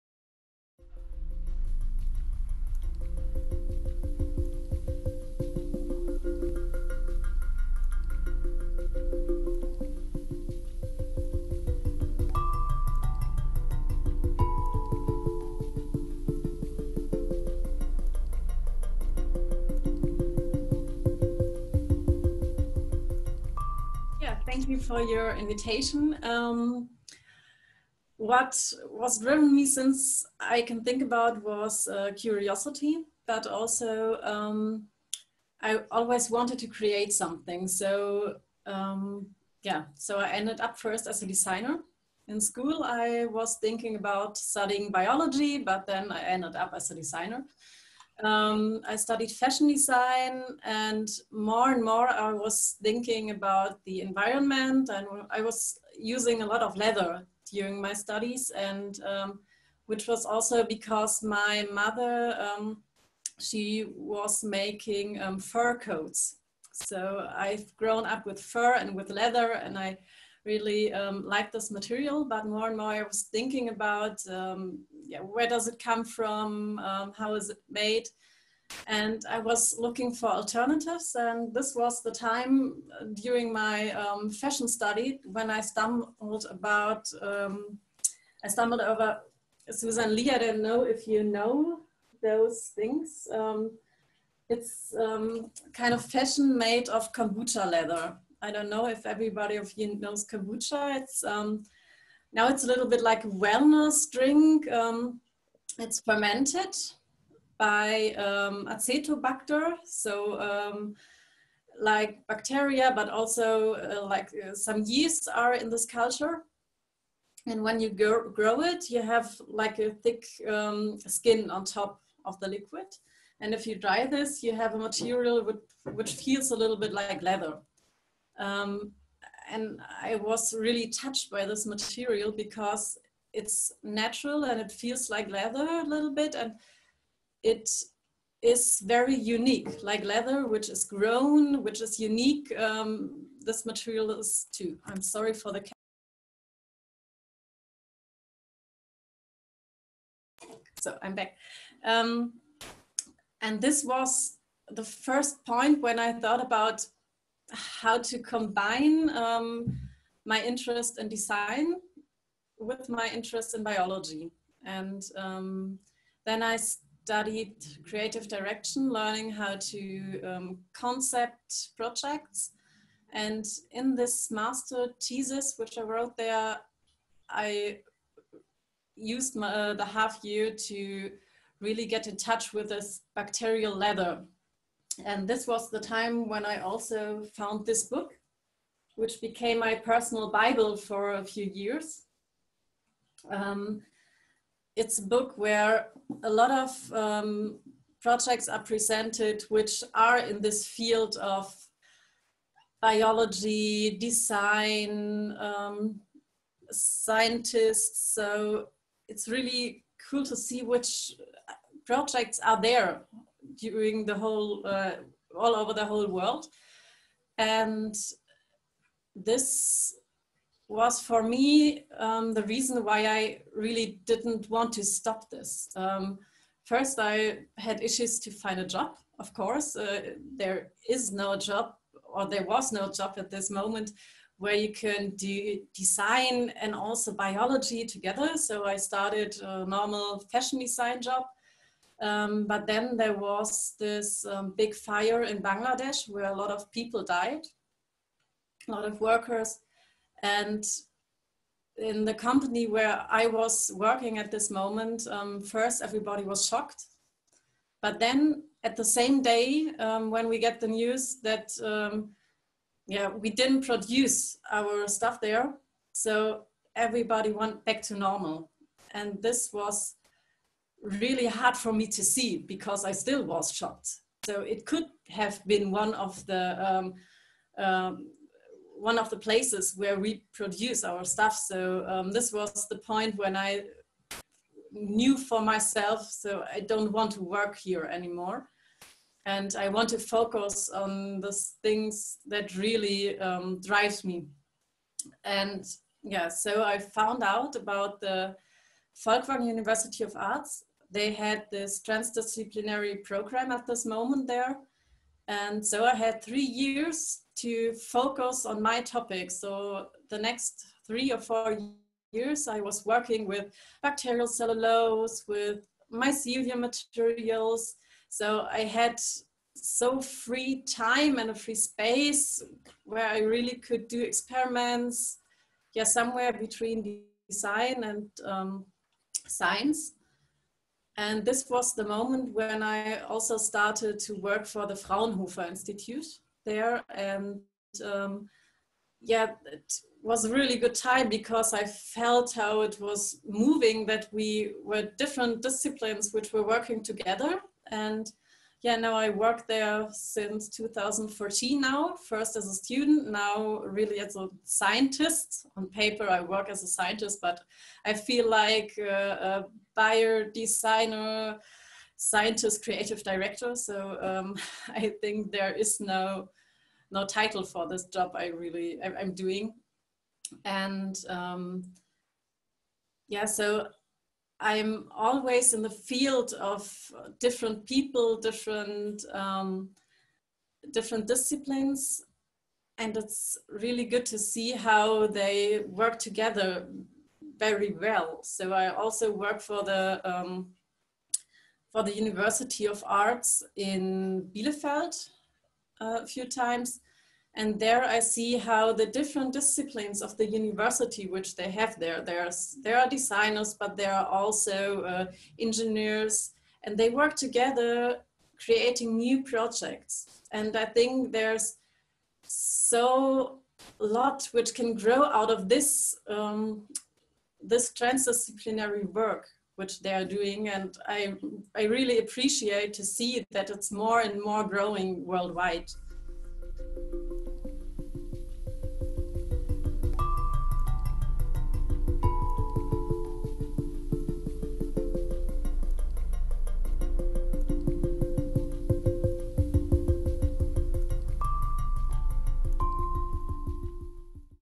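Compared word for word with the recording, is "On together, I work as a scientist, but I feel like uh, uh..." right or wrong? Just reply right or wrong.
wrong.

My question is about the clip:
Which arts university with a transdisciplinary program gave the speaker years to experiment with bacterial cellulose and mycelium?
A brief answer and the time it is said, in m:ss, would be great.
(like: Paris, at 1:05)
Folkwang University of Arts, at 4:58.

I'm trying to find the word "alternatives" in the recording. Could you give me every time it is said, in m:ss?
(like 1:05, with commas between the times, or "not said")
1:20.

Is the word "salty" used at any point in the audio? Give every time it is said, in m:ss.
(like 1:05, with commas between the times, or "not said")
not said.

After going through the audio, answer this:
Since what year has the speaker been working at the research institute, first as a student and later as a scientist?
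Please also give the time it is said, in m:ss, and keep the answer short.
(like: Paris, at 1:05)
2014, at 5:50.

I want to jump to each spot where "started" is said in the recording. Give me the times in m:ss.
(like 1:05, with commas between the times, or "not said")
3:58, 5:33.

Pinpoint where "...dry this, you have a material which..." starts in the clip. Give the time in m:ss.
2:03.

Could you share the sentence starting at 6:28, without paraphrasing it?
So I also work for the um, for the University of Arts in Bielefeld uh, a few times.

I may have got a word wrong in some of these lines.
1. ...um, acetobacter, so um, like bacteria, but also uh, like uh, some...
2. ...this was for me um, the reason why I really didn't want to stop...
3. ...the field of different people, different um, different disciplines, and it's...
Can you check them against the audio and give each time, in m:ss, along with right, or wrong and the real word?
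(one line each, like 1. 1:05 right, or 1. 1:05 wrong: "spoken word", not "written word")
1. 1:48 right
2. 3:39 right
3. 6:15 right.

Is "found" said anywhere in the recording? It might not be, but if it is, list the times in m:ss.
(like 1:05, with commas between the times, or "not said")
3:07, 4:56.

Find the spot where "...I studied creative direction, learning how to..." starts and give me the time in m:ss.
2:46.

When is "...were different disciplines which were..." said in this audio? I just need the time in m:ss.
5:44.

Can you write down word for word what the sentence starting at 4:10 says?
And in the company where I was working at this moment, um, first everybody was shocked.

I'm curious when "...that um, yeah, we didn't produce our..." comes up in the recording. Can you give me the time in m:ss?
4:21.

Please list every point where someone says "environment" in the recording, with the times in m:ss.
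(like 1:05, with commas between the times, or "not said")
0:54.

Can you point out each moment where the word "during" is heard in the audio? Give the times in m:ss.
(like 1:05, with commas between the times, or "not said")
0:57, 1:23, 3:33.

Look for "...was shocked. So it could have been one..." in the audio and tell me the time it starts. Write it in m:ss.
4:33.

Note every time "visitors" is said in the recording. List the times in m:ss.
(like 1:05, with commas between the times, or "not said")
not said.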